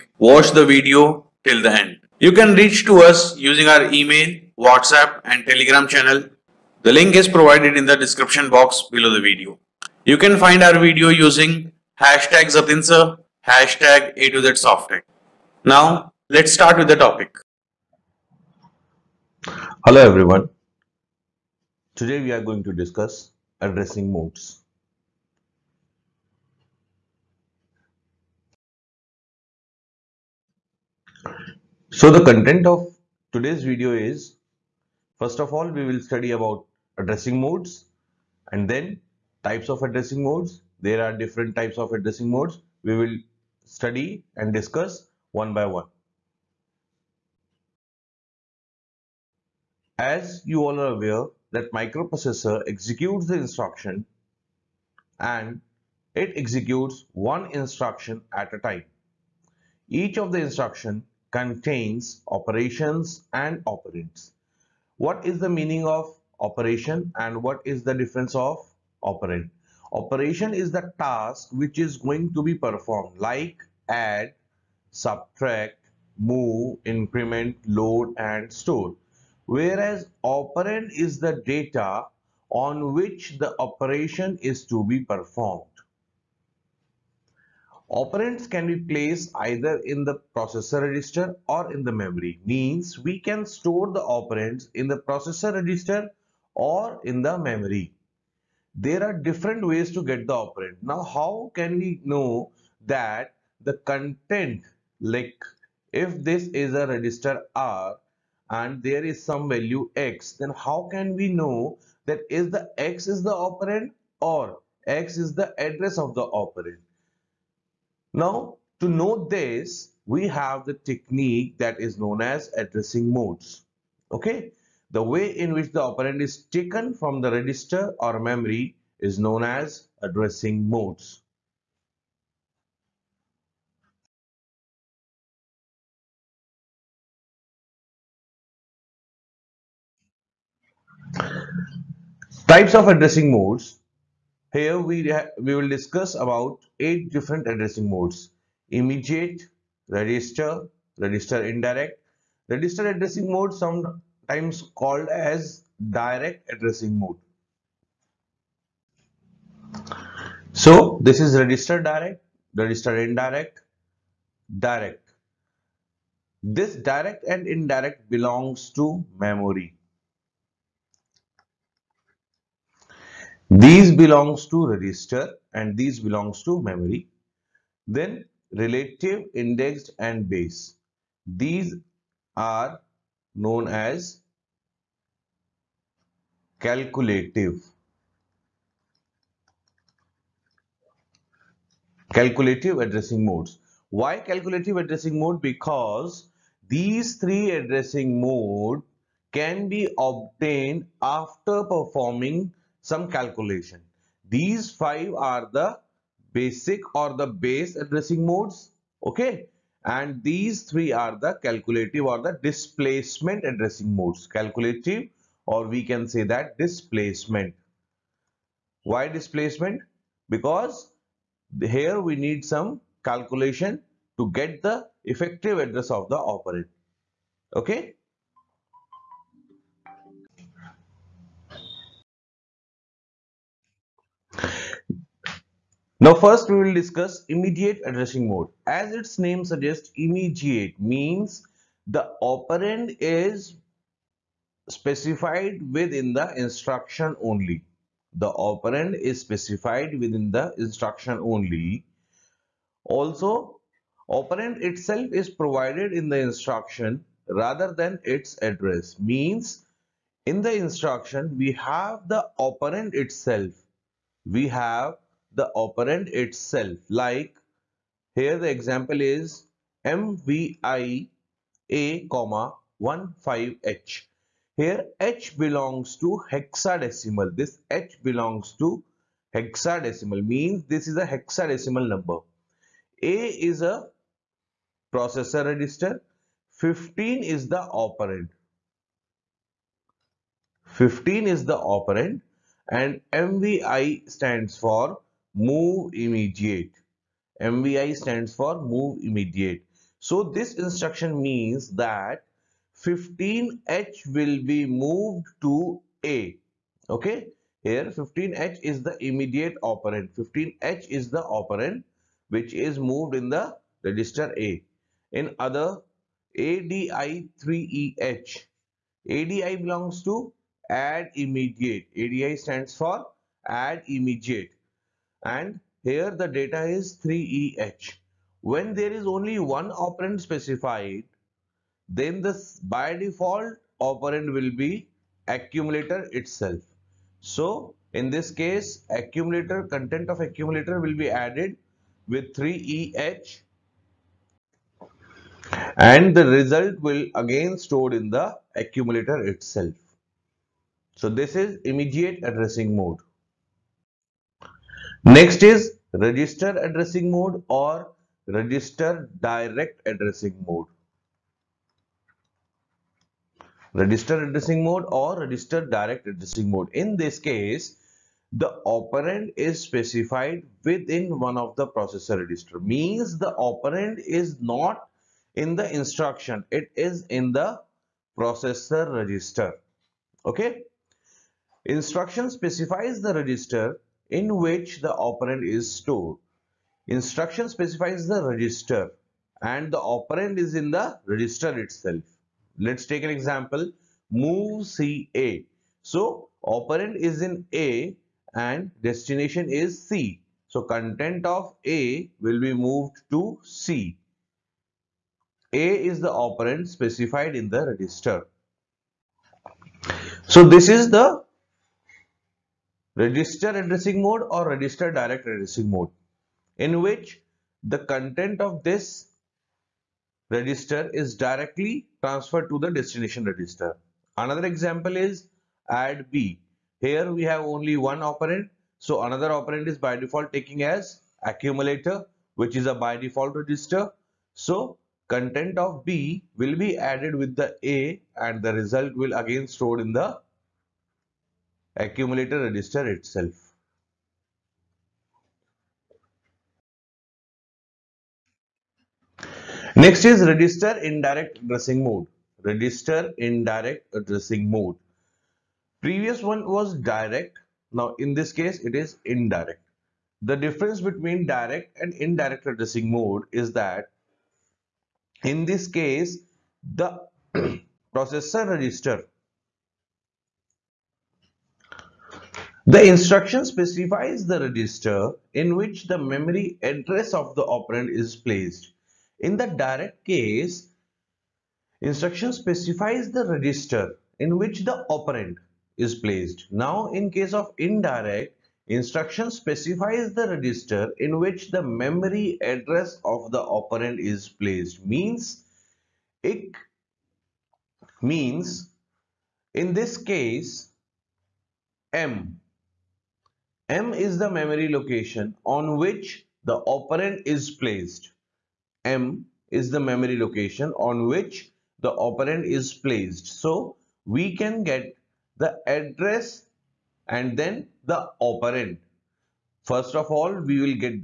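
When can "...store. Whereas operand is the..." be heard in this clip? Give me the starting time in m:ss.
1:18.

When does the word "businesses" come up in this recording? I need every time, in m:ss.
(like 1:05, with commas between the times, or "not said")
not said.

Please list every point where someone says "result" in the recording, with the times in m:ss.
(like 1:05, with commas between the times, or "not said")
5:46, 7:18.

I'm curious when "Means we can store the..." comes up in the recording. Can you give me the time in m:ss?
1:32.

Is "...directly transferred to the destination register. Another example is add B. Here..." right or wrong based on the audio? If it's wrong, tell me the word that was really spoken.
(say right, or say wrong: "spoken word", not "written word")
right.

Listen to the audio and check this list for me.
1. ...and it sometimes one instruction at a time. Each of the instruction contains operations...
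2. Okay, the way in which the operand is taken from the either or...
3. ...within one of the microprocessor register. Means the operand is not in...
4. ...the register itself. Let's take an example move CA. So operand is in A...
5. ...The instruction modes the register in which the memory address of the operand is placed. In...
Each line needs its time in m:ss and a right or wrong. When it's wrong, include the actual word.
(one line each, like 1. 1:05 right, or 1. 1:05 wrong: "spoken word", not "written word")
1. 0:55 wrong: "executes", not "sometimes"
2. 2:04 wrong: "register", not "either"
3. 6:10 wrong: "processor", not "microprocessor"
4. 6:30 right
5. 7:52 wrong: "specifies", not "modes".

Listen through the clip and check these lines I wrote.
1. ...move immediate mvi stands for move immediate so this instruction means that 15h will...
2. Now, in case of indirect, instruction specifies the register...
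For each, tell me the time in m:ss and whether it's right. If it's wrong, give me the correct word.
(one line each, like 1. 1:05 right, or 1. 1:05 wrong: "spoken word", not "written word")
1. 4:55 right
2. 8:06 right.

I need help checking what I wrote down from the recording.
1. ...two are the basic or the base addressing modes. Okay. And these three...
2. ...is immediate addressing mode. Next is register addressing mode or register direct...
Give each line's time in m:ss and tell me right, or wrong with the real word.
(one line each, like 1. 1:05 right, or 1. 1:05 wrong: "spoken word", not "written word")
1. 3:24 wrong: "five", not "two"
2. 5:51 right.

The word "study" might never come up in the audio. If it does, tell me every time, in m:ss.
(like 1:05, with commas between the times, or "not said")
0:35, 0:43.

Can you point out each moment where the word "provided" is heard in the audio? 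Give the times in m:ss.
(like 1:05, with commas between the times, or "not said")
0:07, 4:15.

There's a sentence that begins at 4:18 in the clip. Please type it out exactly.
Means in the instruction, we have the operand itself.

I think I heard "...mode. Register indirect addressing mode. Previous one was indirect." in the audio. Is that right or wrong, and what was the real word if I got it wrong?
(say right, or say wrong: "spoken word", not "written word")
wrong: "direct", not "indirect".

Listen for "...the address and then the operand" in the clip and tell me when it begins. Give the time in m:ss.
8:35.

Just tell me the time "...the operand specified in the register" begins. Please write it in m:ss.
6:46.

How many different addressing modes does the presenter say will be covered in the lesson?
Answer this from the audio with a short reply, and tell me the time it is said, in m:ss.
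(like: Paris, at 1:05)
8, at 2:26.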